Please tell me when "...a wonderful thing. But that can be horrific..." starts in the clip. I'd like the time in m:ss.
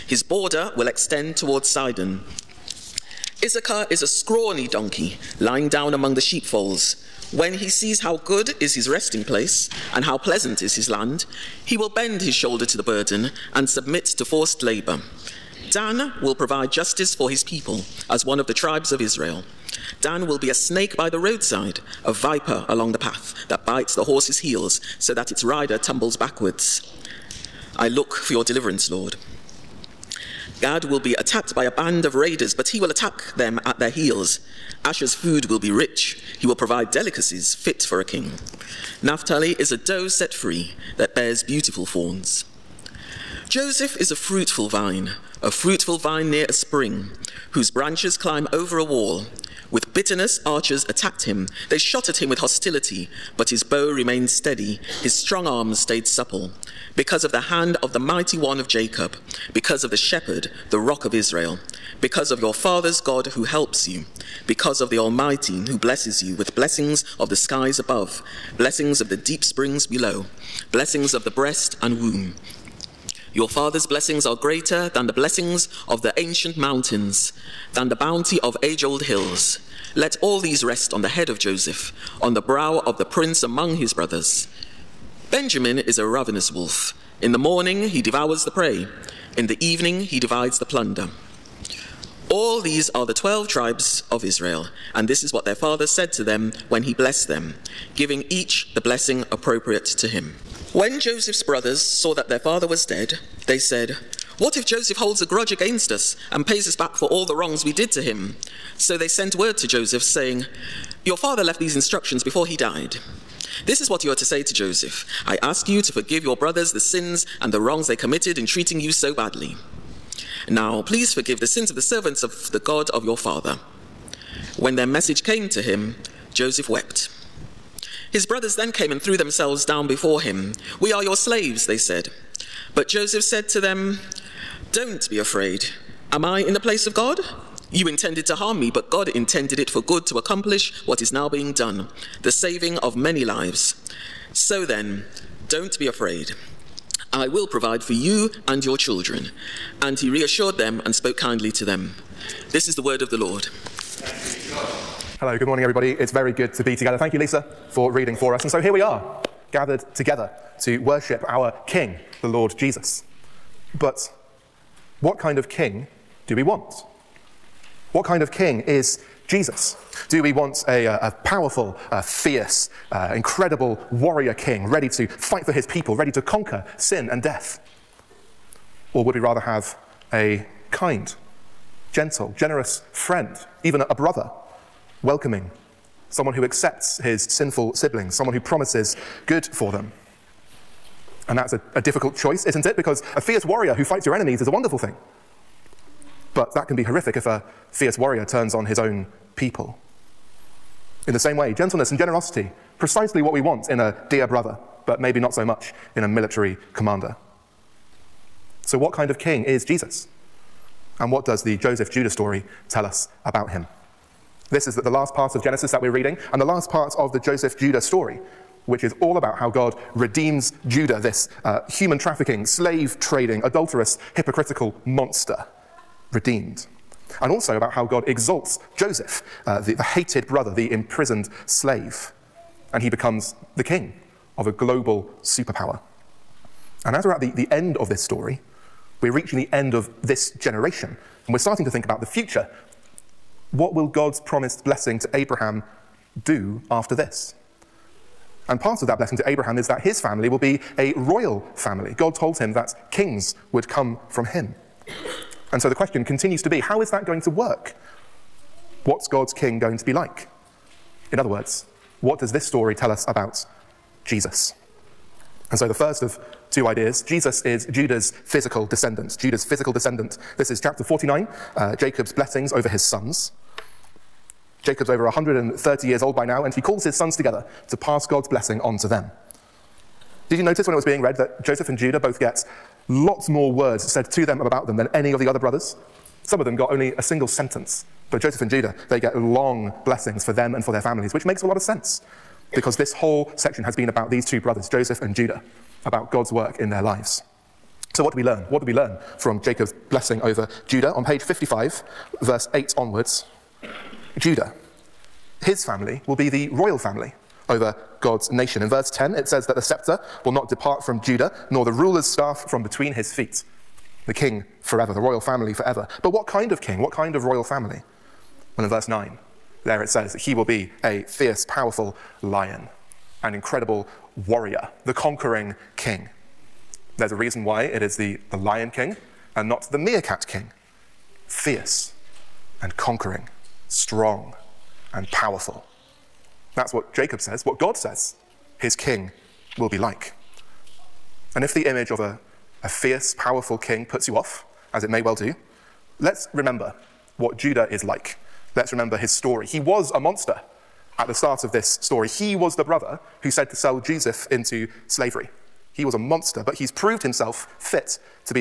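3:14.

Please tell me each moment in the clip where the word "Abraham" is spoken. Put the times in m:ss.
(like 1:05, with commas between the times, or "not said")
4:05, 4:09.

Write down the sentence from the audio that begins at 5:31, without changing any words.
Fierce and conquering, strong and powerful.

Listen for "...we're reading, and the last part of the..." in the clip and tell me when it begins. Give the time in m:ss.
3:35.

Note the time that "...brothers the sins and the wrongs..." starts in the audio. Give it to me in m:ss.
1:56.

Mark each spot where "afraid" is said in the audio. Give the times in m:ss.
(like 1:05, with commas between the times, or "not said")
2:15, 2:25.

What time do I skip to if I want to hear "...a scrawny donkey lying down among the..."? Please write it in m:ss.
0:04.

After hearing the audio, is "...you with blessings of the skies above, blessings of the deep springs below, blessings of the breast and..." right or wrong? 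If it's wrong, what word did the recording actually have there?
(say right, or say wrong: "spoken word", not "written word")
right.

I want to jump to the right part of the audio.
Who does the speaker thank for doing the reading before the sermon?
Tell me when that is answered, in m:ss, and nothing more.
2:37.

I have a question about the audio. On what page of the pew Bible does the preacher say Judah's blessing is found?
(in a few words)
55.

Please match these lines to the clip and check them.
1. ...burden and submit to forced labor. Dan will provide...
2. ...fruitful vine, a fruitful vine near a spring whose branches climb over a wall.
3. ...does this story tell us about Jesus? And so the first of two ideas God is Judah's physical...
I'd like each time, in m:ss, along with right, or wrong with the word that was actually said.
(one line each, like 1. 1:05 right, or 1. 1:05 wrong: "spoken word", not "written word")
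1. 0:12 right
2. 0:44 right
3. 4:22 wrong: "Jesus", not "God".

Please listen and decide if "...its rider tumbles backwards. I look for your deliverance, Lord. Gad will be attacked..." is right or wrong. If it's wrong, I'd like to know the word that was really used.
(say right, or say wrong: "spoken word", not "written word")
right.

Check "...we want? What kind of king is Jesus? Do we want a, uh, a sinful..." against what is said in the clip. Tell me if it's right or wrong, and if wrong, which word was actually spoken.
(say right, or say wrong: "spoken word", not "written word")
wrong: "powerful", not "sinful".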